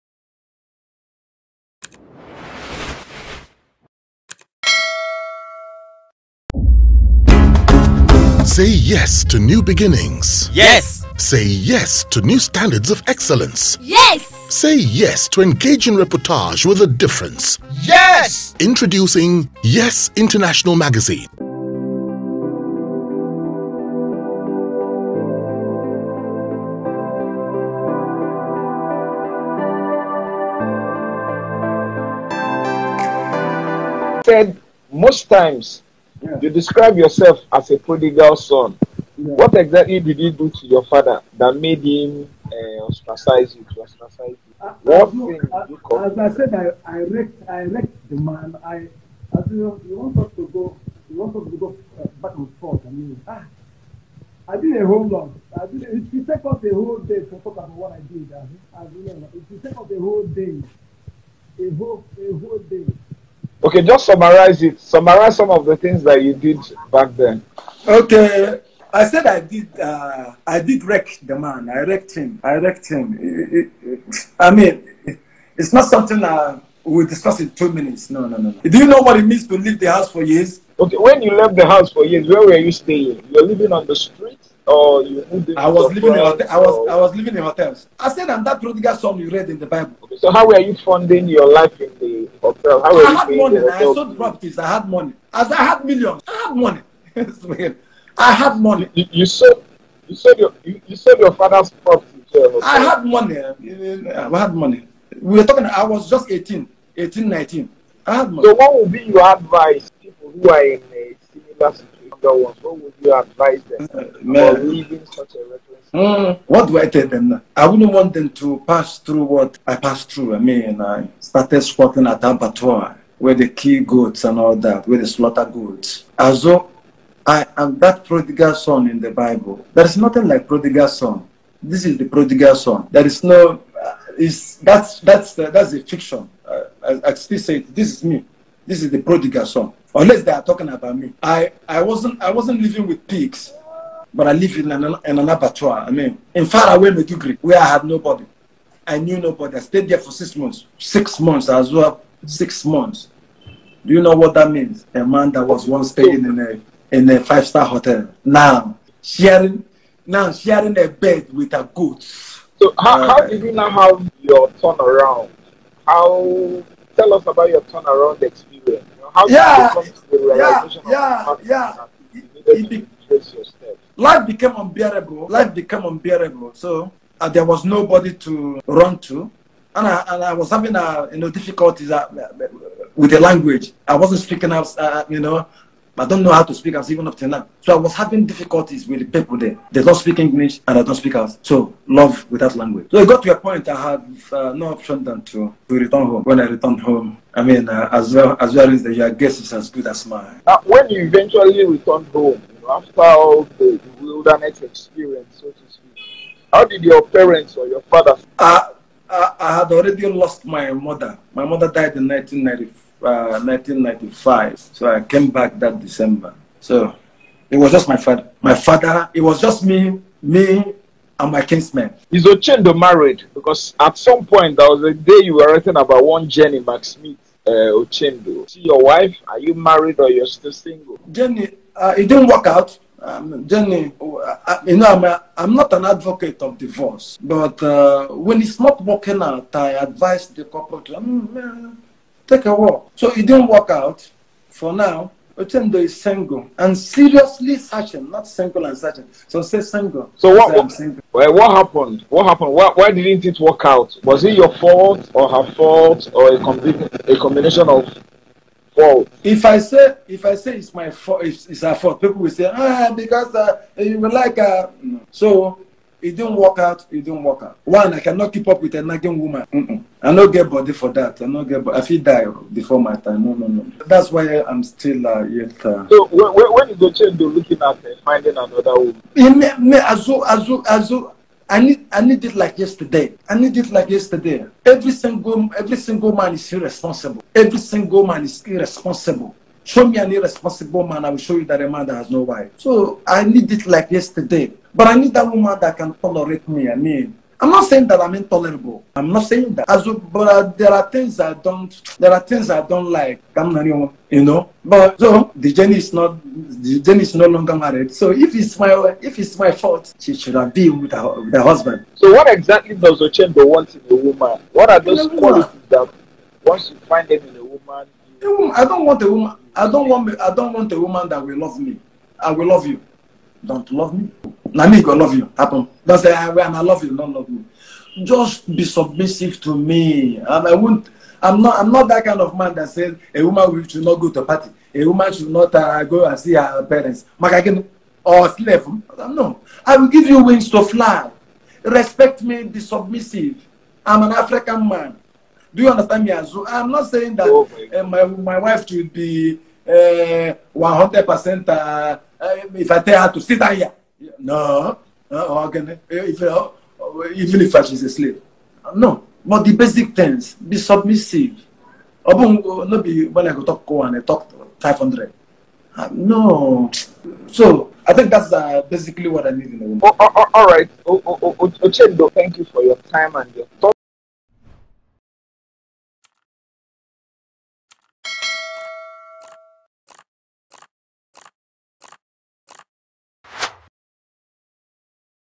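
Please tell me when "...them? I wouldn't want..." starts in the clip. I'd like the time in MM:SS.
01:57.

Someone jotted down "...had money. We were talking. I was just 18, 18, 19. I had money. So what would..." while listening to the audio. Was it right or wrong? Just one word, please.
right.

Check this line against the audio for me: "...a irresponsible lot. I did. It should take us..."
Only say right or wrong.
wrong.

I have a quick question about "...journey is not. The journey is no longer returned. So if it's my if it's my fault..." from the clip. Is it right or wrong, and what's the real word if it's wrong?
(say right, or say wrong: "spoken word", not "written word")
wrong: "married", not "returned".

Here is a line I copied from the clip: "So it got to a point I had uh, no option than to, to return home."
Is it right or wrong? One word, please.
right.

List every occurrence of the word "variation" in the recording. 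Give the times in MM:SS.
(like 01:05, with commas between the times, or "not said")
not said.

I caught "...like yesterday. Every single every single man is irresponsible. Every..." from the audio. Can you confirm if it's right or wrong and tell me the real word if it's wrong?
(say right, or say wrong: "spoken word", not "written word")
right.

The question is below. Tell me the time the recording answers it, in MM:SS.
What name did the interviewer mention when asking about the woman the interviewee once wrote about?
03:46.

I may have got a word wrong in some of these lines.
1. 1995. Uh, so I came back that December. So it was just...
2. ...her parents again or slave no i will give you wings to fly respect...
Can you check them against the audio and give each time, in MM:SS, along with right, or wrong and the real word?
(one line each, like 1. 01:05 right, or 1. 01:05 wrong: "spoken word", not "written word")
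1. 03:33 right
2. 05:36 right.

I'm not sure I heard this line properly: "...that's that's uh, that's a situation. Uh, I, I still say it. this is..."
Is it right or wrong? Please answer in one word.
wrong.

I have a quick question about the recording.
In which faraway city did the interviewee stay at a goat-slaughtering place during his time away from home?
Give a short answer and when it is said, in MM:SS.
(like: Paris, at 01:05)
Maiduguri, at 02:26.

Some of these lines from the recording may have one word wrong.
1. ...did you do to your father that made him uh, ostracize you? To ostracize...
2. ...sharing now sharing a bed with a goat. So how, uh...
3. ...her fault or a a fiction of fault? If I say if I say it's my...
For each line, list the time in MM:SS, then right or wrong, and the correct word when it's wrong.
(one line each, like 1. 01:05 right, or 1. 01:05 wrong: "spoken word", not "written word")
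1. 00:39 right
2. 02:39 right
3. 04:15 wrong: "combination", not "fiction".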